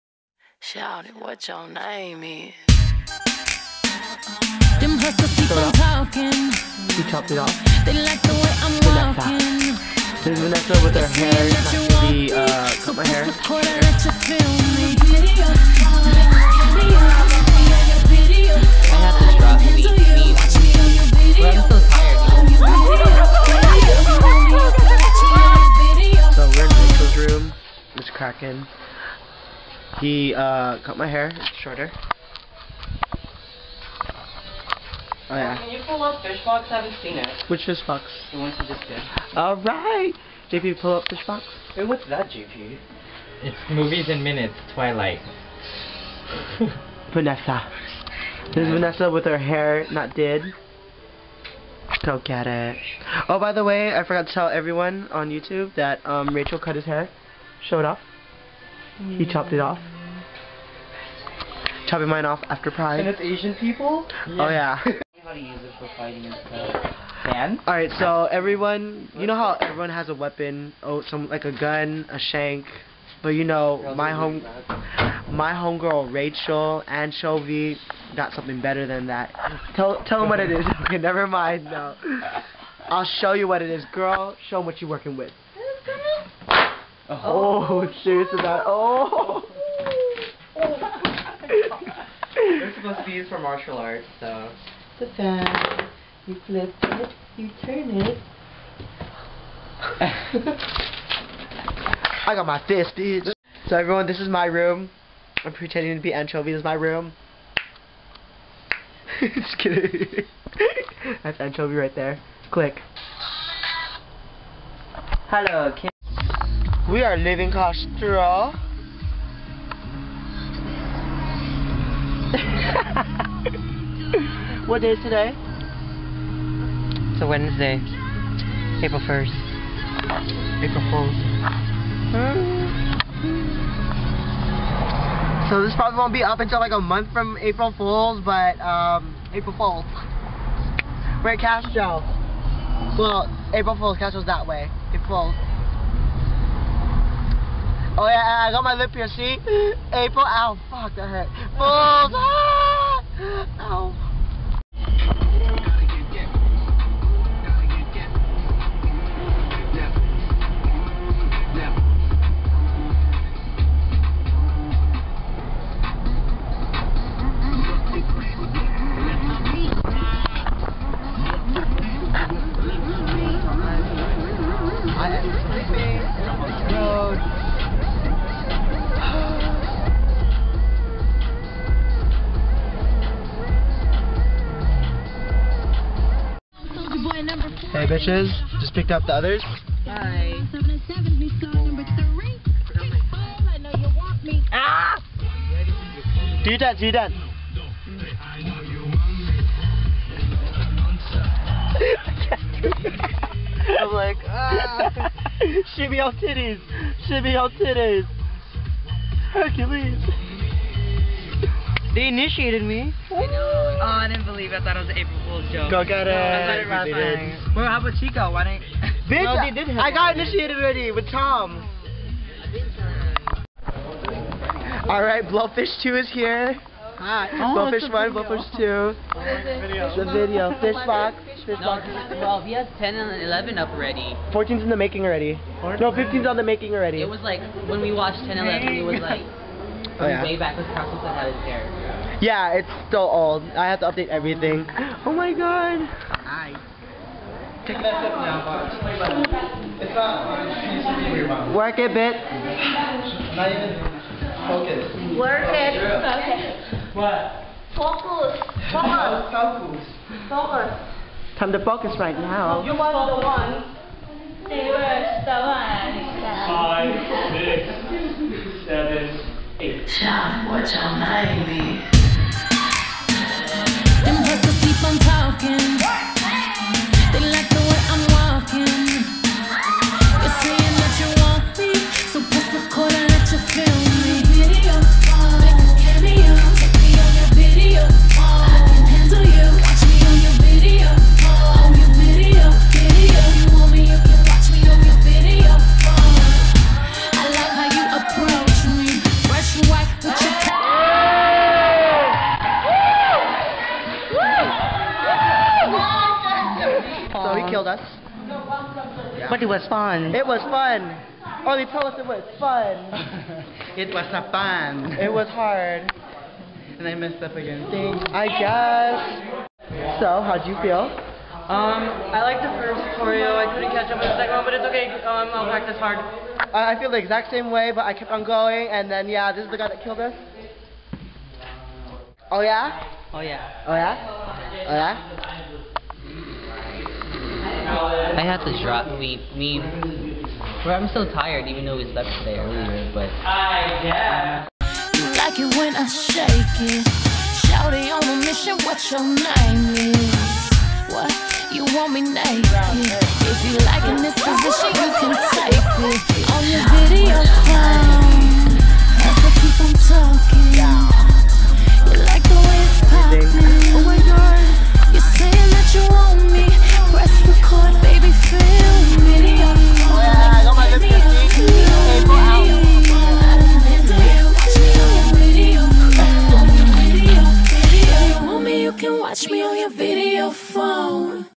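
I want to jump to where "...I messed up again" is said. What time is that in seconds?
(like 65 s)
316 s.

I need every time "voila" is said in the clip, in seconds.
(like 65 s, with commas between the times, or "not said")
not said.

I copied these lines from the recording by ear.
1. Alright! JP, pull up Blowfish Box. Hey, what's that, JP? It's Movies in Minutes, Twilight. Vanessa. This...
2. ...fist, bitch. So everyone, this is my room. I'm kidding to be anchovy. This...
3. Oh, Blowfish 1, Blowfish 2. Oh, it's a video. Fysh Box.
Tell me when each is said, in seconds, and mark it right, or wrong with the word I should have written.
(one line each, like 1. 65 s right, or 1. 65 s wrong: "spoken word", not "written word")
1. 39 s wrong: "Fysh", not "Blowfish"
2. 102 s wrong: "pretending", not "kidding"
3. 227 s right.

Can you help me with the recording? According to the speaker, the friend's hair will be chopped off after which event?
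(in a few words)
Pride.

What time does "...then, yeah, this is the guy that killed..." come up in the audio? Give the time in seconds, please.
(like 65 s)
328 s.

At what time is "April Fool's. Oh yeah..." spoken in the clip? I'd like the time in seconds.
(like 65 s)
144 s.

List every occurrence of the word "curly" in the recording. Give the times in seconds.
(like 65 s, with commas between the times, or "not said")
not said.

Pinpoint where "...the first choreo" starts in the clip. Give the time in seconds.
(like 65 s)
322 s.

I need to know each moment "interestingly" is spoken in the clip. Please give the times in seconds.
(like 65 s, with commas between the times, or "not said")
not said.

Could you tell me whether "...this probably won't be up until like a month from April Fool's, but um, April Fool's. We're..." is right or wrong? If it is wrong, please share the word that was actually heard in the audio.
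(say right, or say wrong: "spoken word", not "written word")
right.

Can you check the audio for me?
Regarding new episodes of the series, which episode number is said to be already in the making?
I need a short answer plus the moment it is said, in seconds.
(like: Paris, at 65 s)
15, at 235 s.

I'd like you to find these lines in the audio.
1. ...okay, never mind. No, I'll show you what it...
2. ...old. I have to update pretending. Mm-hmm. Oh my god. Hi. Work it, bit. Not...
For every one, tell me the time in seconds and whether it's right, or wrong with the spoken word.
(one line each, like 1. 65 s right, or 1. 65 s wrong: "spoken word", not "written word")
1. 80 s right
2. 243 s wrong: "everything", not "pretending".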